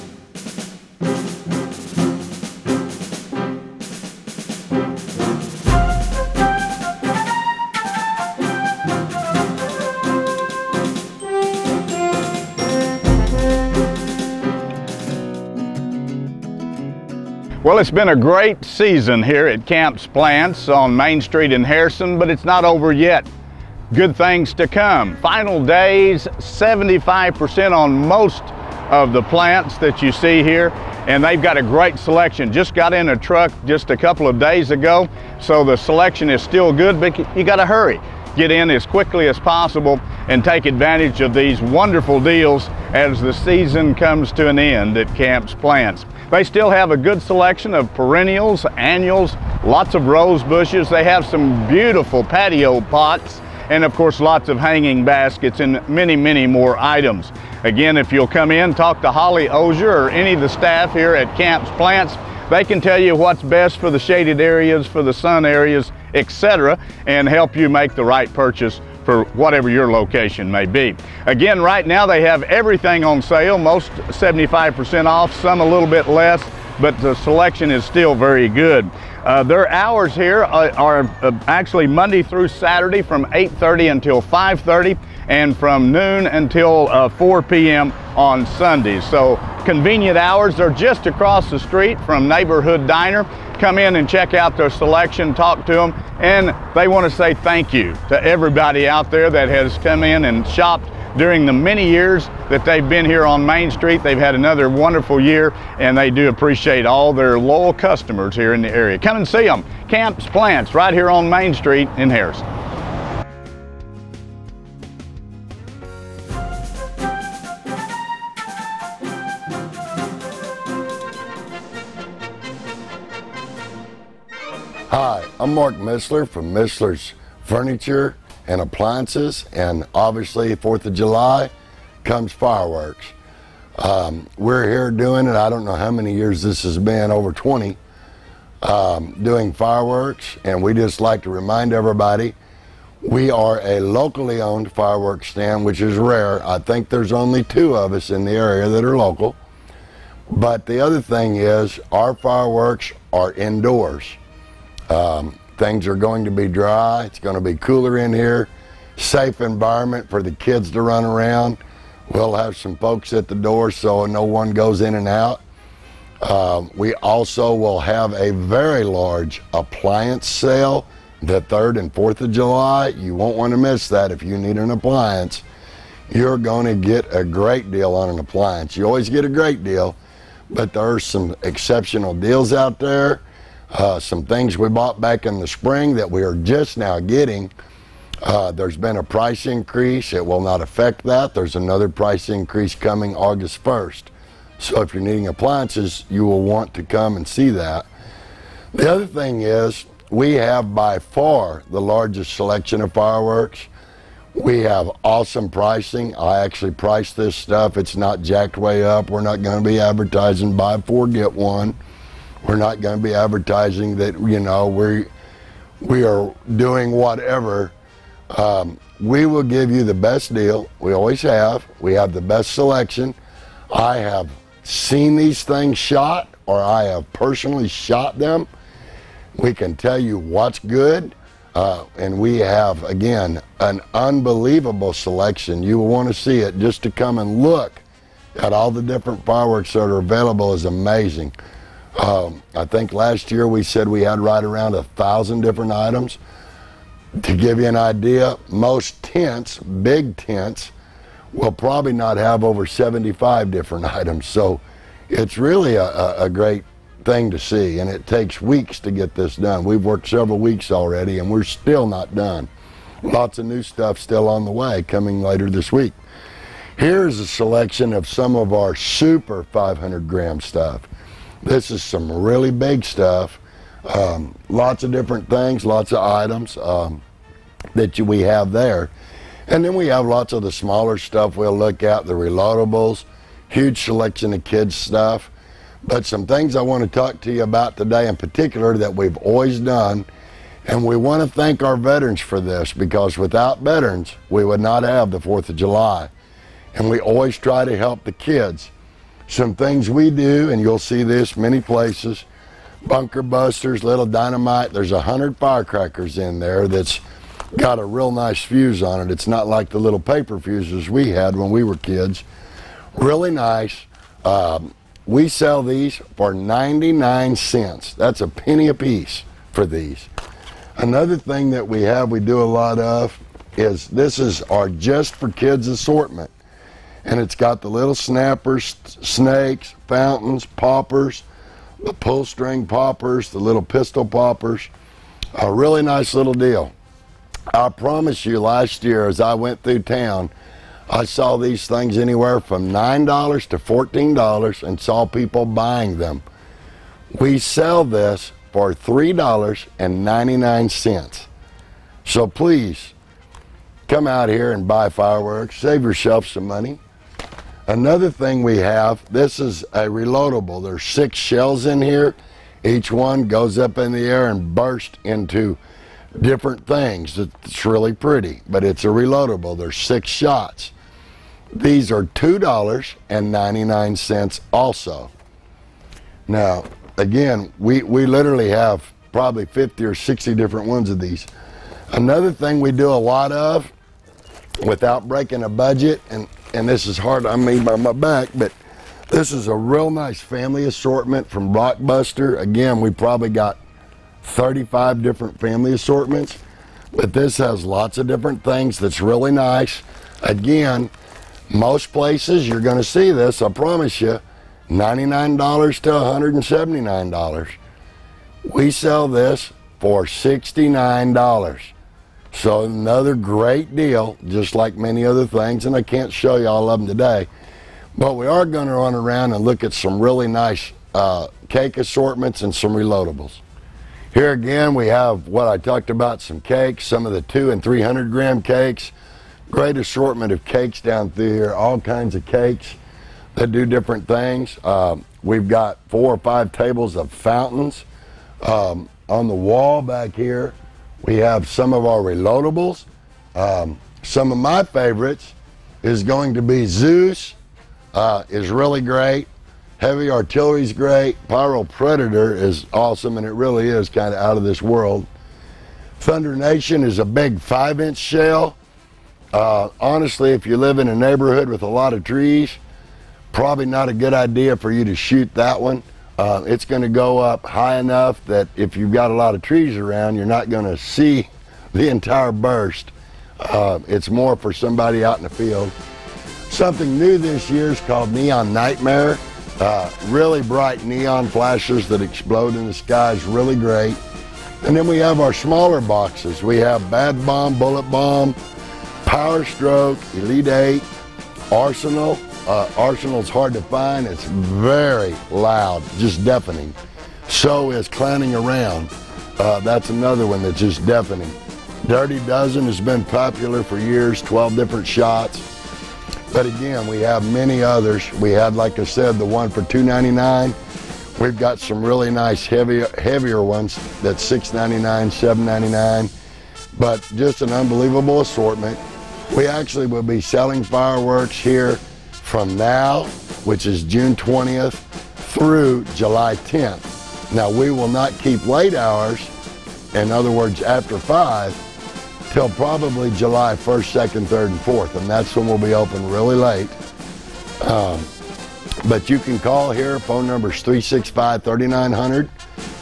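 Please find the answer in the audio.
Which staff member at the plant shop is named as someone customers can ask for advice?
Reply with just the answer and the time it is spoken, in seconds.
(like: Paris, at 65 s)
Holly Osier, at 59 s.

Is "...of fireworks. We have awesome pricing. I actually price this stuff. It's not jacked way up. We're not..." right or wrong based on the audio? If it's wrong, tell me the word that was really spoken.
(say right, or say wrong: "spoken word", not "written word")
right.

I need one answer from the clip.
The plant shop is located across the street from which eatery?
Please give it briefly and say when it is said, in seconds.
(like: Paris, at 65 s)
Neighborhood Diner, at 92 s.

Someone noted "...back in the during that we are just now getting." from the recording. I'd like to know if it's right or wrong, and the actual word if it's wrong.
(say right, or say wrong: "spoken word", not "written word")
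wrong: "spring", not "during".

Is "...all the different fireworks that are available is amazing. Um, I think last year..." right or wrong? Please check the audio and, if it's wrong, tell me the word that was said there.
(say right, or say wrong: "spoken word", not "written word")
right.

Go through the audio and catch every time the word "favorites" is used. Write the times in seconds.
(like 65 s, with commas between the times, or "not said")
444 s.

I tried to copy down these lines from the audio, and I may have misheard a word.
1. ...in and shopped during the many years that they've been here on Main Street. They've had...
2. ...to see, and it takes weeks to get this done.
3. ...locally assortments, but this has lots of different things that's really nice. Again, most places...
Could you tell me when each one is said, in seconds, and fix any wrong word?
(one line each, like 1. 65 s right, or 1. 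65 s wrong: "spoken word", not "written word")
1. 100 s right
2. 257 s right
3. 395 s wrong: "family", not "locally".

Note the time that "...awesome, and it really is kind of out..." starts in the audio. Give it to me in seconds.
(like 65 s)
452 s.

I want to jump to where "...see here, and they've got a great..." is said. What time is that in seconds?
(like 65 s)
30 s.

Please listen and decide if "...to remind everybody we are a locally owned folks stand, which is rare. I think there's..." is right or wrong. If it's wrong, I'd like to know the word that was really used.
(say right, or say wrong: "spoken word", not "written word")
wrong: "fireworks", not "folks".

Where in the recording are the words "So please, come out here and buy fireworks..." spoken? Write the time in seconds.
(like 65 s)
352 s.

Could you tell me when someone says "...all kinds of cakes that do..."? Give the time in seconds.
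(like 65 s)
431 s.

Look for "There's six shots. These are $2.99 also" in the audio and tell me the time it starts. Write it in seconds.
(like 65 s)
369 s.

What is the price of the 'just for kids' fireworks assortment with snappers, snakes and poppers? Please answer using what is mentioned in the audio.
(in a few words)
$3.99.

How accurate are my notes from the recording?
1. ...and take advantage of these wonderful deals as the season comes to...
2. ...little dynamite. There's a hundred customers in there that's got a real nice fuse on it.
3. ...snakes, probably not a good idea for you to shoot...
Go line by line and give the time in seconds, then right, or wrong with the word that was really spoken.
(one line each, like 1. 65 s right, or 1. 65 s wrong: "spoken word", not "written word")
1. 40 s right
2. 303 s wrong: "firecrackers", not "customers"
3. 462 s wrong: "trees", not "snakes".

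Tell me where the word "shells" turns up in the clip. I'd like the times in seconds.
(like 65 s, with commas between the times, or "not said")
361 s, 457 s.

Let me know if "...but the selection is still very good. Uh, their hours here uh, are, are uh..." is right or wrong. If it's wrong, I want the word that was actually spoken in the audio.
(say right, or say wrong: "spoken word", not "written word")
right.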